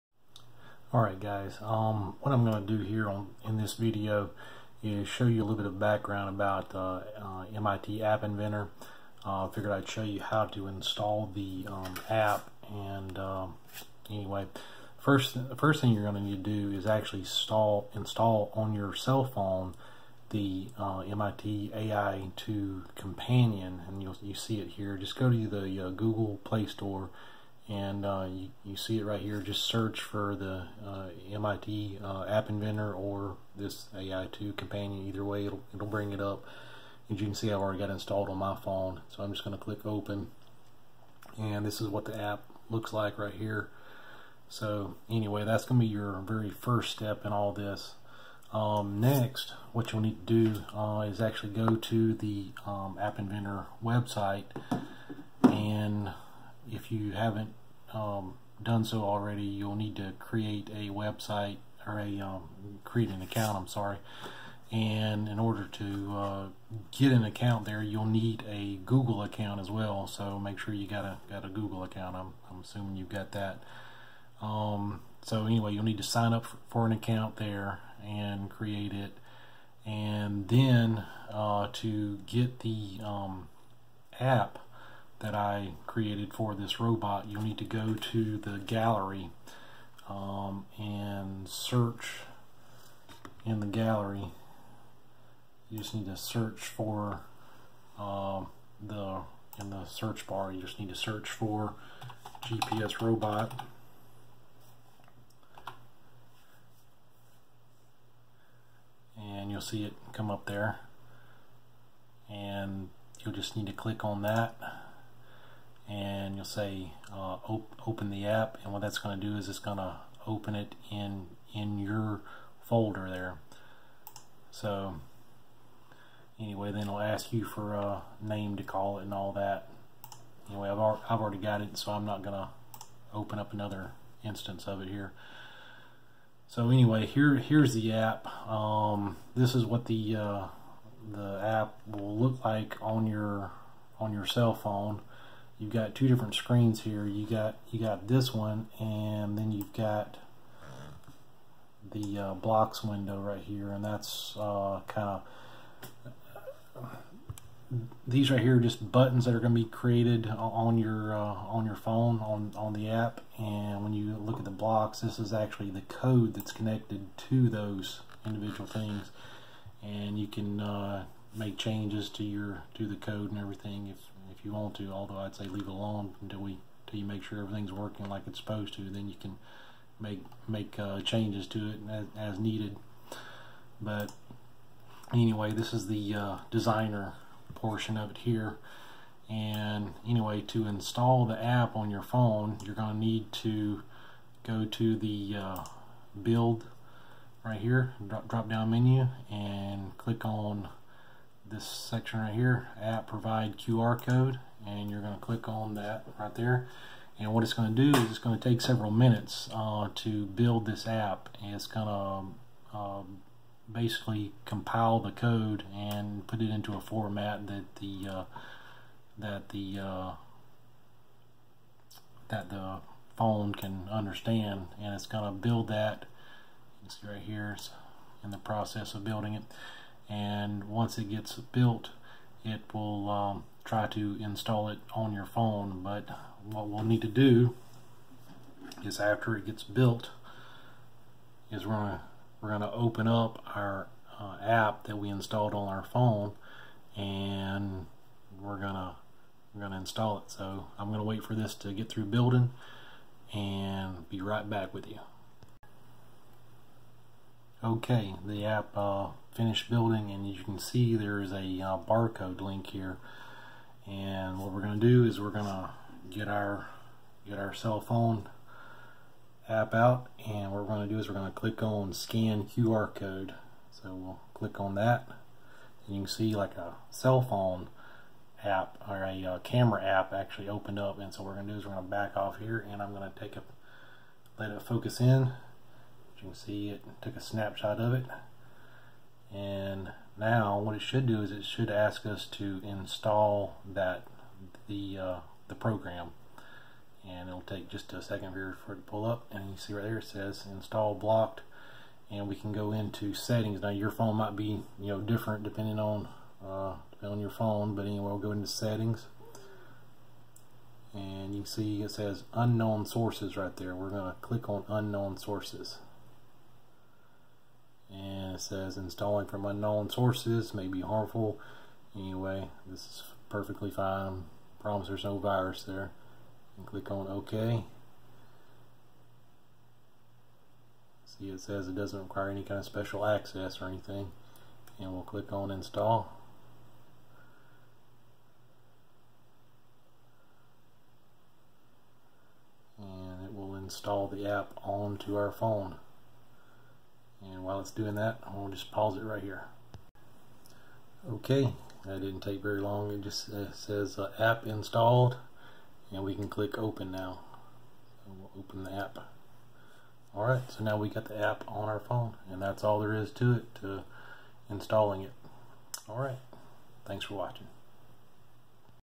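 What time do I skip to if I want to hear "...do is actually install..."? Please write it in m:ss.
0:16.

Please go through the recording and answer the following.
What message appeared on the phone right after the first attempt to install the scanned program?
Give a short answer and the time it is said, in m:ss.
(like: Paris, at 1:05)
install blocked, at 5:00.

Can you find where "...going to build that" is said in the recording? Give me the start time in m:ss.
3:45.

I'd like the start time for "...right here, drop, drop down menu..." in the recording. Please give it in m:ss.
3:17.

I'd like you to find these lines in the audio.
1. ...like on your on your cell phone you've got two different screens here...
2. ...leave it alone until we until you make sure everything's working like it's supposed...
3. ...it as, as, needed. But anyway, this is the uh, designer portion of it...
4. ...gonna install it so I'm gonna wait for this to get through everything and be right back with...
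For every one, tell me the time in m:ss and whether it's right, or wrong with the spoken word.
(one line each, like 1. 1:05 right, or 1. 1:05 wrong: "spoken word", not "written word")
1. 2:22 right
2. 2:55 right
3. 3:01 right
4. 4:09 wrong: "building", not "everything".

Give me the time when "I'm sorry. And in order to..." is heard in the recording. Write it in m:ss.
1:03.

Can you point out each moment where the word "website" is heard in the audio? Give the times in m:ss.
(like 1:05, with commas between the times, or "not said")
0:53, 1:00.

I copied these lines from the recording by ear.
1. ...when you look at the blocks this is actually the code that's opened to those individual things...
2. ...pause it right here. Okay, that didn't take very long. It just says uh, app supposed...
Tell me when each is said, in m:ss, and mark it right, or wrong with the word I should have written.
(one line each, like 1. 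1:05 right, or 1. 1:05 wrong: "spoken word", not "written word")
1. 2:43 wrong: "connected", not "opened"
2. 5:48 wrong: "installed", not "supposed".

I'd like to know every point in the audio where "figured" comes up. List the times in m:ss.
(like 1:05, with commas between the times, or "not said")
0:09.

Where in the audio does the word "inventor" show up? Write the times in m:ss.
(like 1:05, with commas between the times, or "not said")
0:08, 0:32, 0:53.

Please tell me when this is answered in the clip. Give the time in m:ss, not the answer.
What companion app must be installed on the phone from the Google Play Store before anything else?
0:21.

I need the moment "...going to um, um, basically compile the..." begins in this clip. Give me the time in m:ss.
3:31.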